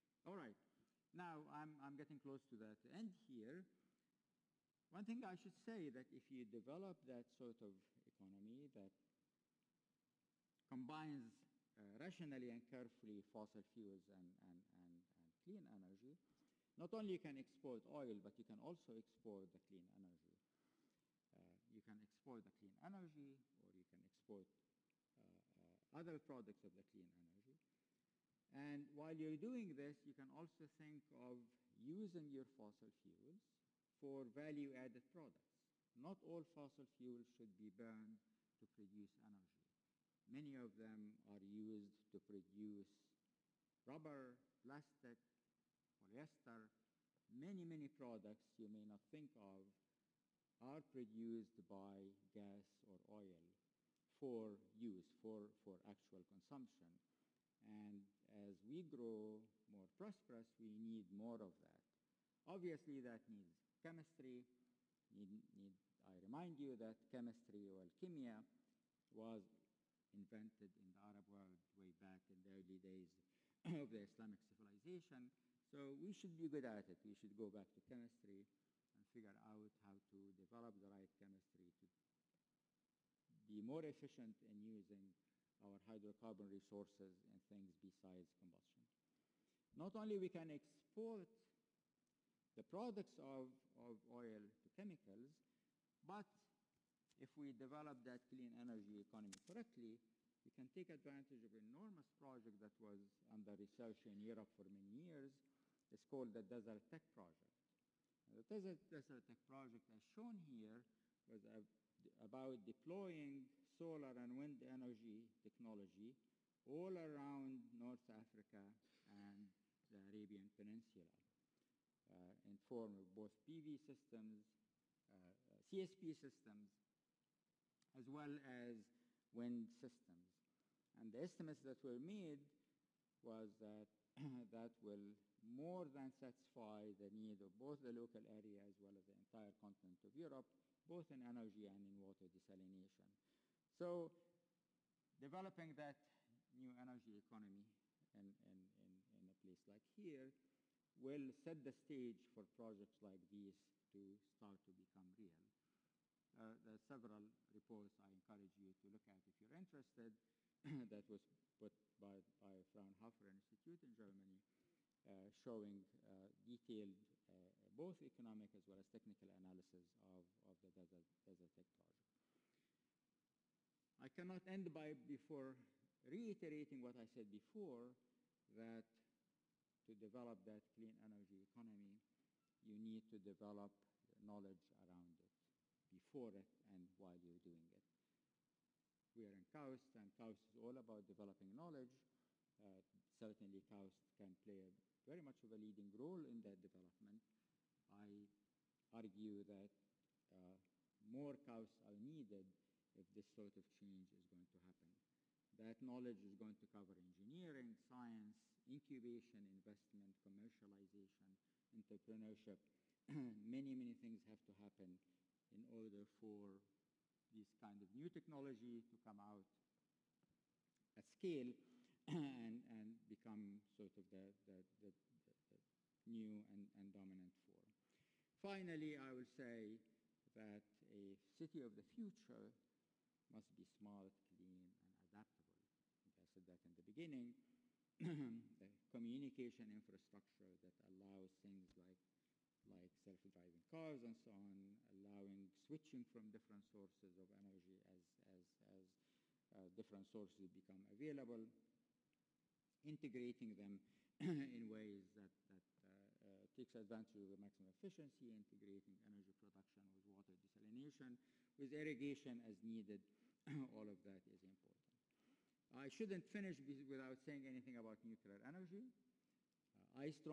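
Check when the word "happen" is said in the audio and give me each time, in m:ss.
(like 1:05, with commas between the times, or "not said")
3:24, 3:34.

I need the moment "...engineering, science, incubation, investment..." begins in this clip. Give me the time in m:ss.
3:26.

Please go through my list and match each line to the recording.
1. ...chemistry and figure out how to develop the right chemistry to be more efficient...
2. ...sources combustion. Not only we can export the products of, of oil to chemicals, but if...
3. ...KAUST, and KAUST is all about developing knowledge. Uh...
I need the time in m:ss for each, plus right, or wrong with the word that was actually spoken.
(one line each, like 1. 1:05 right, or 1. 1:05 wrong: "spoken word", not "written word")
1. 1:17 right
2. 1:27 wrong: "besides", not "sources"
3. 3:09 right.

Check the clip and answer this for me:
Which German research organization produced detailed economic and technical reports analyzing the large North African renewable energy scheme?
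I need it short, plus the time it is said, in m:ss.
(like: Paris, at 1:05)
Fraunhofer Institute, at 2:42.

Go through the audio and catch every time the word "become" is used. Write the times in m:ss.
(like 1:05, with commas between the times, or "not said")
2:34, 3:43, 4:10.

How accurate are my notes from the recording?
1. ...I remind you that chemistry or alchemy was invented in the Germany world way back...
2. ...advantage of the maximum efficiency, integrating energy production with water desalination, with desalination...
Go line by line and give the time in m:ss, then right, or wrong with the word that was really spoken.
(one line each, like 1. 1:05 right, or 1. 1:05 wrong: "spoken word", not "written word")
1. 1:06 wrong: "Arab", not "Germany"
2. 4:16 wrong: "irrigation", not "desalination".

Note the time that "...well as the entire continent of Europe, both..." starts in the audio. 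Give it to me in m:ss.
2:18.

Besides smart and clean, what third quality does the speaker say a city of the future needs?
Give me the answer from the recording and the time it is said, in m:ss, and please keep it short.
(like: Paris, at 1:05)
adaptable, at 3:55.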